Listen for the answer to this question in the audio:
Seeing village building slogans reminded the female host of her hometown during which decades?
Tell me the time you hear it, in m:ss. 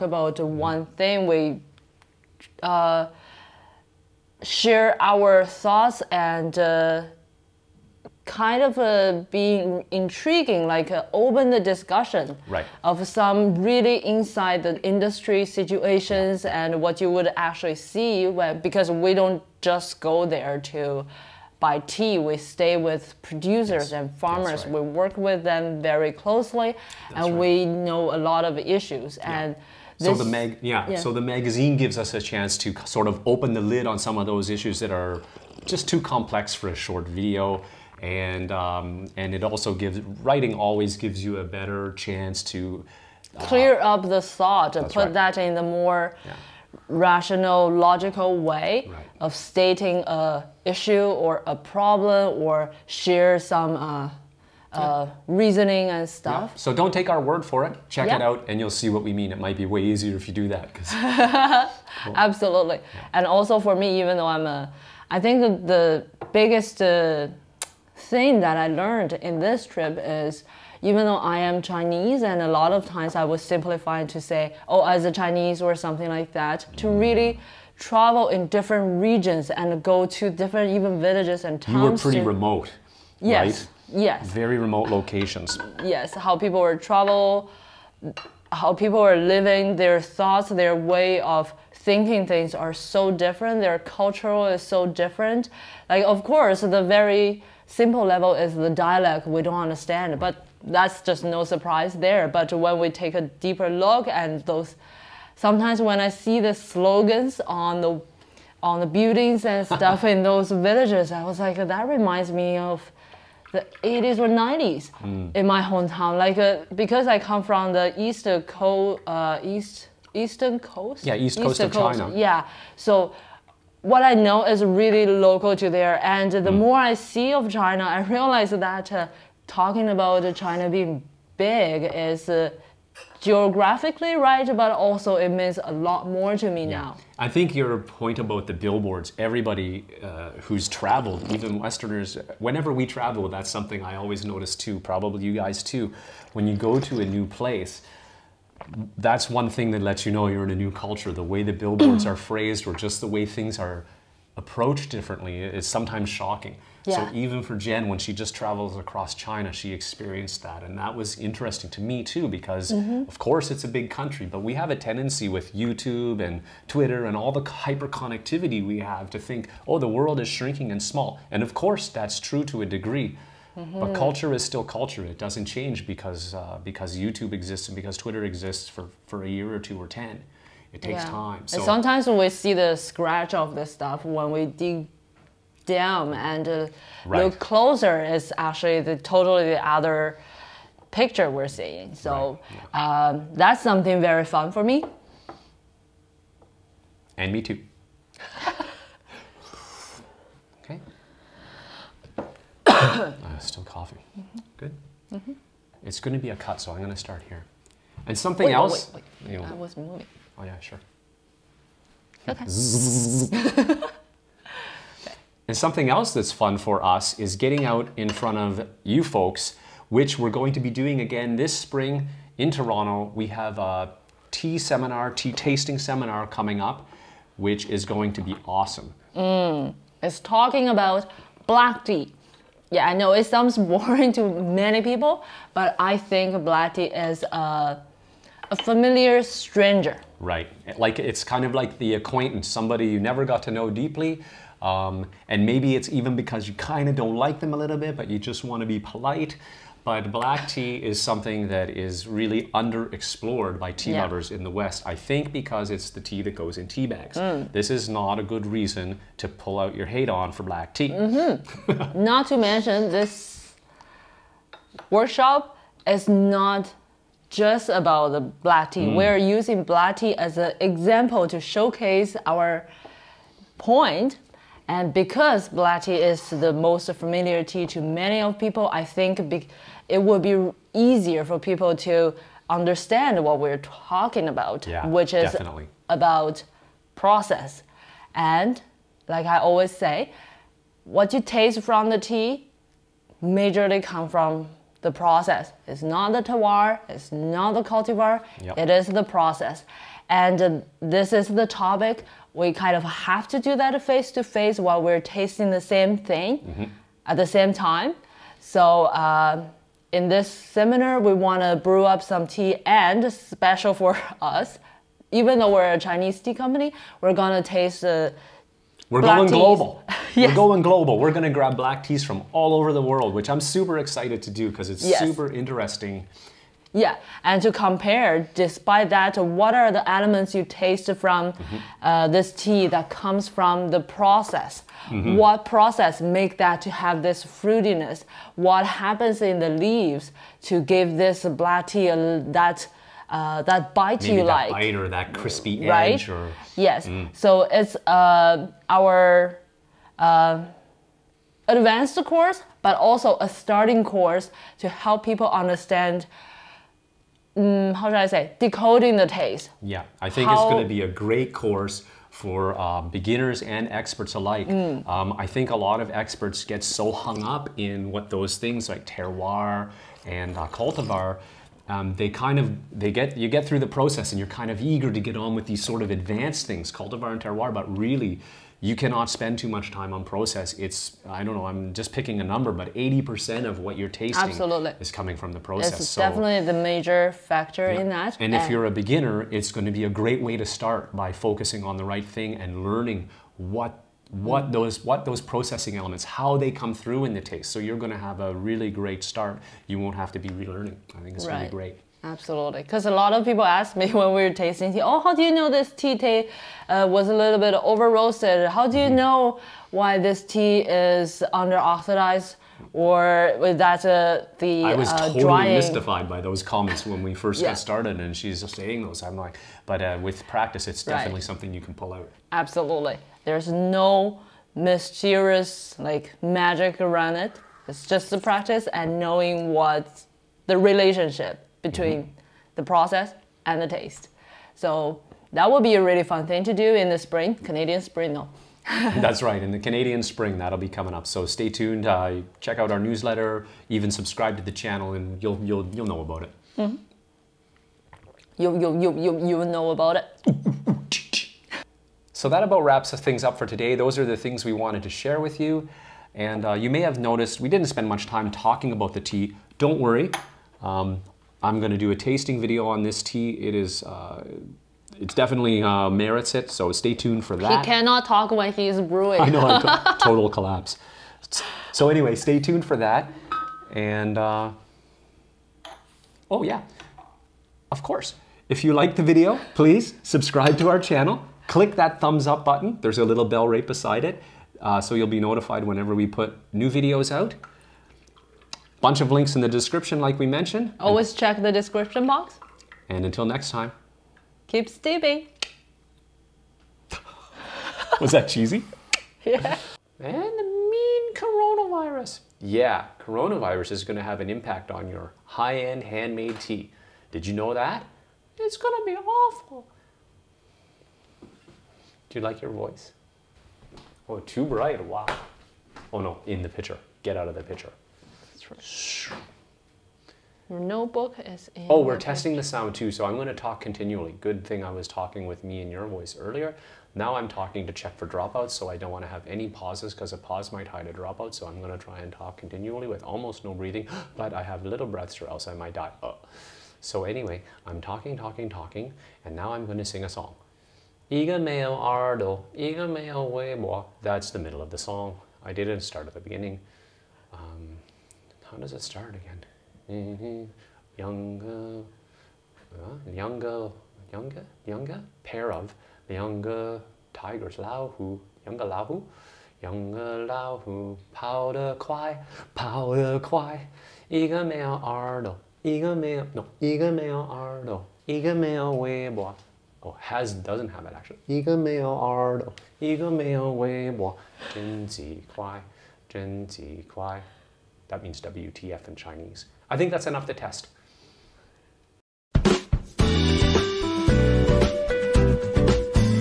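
1:53.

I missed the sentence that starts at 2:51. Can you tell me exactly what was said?
And of course that's true to a degree.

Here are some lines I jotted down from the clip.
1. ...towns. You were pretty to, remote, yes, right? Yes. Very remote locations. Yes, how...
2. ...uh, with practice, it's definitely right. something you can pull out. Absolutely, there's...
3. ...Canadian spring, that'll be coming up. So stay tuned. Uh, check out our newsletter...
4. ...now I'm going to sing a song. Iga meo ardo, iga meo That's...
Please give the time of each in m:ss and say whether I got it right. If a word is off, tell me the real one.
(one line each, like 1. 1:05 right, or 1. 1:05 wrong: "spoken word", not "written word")
1. 1:21 right
2. 6:59 right
3. 7:19 right
4. 8:59 right.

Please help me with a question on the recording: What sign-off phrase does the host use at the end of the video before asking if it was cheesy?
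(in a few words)
keep steeping.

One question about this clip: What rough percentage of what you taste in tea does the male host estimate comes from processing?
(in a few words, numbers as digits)
80%.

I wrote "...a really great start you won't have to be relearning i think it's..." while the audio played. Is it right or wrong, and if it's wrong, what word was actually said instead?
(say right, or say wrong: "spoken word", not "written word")
right.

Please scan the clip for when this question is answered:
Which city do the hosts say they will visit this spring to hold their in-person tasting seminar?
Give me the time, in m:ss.
3:42.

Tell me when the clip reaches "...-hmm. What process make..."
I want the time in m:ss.
5:35.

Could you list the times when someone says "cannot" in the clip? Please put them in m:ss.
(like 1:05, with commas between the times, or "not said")
6:18, 7:47.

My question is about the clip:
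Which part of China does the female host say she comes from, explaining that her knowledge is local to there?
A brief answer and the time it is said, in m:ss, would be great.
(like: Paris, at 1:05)
eastern coast, at 1:59.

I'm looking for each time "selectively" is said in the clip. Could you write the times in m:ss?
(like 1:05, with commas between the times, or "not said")
not said.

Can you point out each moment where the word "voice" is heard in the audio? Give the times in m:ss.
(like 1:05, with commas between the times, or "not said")
8:32, 8:45.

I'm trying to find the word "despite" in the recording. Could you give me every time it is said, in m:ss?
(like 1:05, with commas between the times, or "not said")
5:28.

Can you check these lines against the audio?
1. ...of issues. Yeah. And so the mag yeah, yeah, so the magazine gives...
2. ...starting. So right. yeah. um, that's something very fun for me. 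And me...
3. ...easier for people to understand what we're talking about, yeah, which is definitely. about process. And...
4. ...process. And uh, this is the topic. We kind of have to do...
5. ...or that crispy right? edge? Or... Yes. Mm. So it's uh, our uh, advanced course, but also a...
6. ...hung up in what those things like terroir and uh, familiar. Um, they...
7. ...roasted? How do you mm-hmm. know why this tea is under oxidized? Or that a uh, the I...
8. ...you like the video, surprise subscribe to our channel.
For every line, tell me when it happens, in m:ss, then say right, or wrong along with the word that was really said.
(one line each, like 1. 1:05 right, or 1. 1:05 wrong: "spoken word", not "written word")
1. 0:28 right
2. 3:11 wrong: "seeing", not "starting"
3. 4:40 right
4. 4:59 right
5. 5:44 right
6. 6:06 wrong: "cultivar", not "familiar"
7. 6:47 right
8. 7:58 wrong: "please", not "surprise".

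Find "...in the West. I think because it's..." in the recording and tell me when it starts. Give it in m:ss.
4:14.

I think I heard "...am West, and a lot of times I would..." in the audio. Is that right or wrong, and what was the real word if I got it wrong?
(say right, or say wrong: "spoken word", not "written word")
wrong: "Chinese", not "West".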